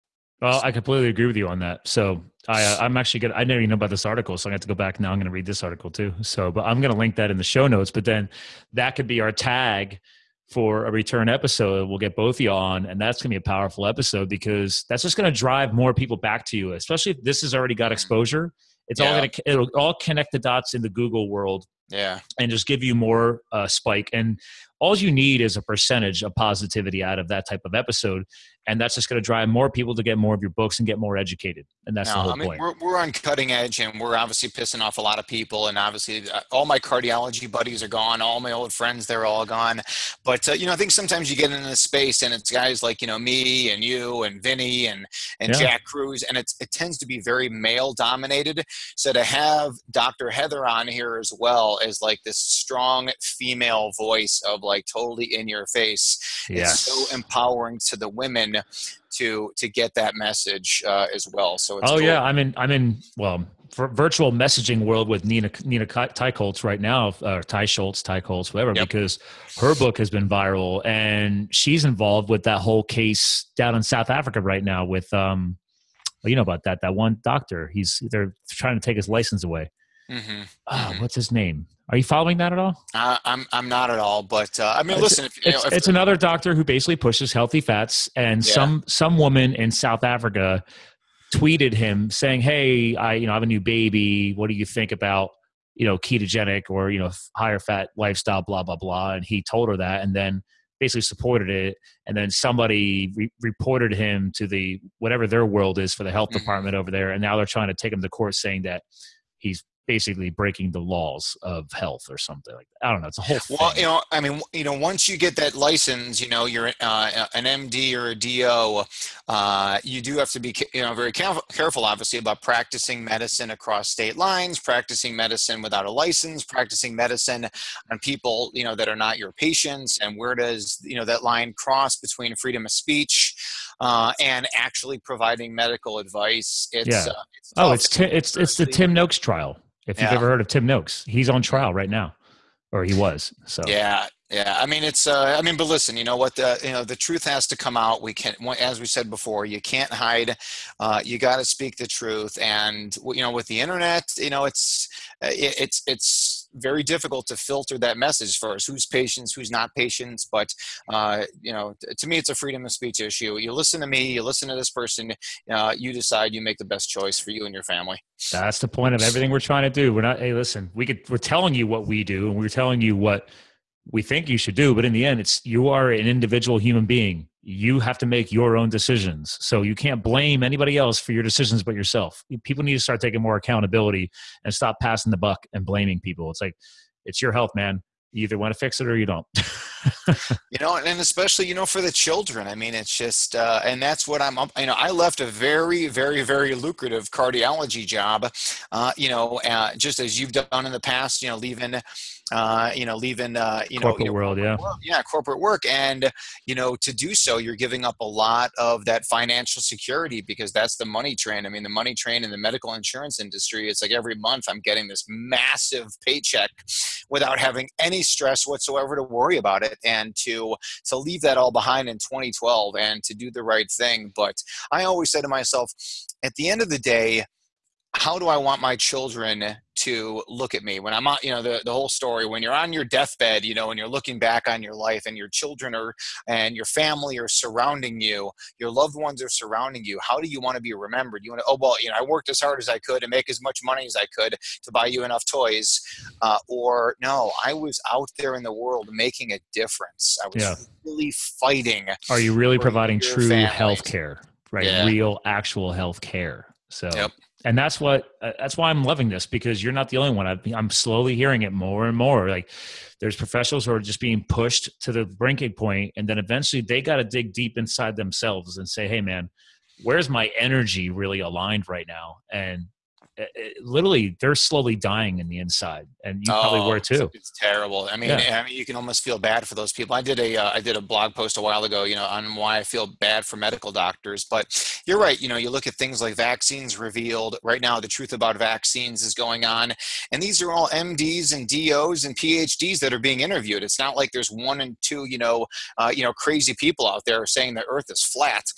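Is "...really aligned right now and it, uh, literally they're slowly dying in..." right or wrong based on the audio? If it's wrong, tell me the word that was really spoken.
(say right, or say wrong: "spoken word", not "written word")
right.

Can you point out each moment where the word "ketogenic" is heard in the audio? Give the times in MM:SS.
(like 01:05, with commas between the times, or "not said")
01:35.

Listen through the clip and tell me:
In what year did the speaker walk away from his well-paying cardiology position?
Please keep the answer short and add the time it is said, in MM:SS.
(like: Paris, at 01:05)
2012, at 03:41.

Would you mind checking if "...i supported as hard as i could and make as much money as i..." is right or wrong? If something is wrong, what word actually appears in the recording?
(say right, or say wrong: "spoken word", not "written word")
wrong: "worked", not "supported".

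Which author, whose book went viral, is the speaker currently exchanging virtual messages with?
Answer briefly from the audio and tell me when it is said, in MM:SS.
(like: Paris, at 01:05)
Nina Teicholz, at 01:05.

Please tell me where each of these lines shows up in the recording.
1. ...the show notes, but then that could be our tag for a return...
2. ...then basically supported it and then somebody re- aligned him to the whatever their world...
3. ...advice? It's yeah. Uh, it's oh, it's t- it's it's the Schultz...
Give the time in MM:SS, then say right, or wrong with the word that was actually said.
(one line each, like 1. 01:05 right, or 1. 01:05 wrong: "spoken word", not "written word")
1. 00:07 right
2. 01:40 wrong: "reported", not "aligned"
3. 02:15 wrong: "Tim", not "Schultz".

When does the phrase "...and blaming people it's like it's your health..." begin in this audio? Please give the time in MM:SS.
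03:05.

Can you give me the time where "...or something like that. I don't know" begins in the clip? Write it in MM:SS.
01:52.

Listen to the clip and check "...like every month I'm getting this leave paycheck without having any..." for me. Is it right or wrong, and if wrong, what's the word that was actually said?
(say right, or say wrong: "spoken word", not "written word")
wrong: "massive", not "leave".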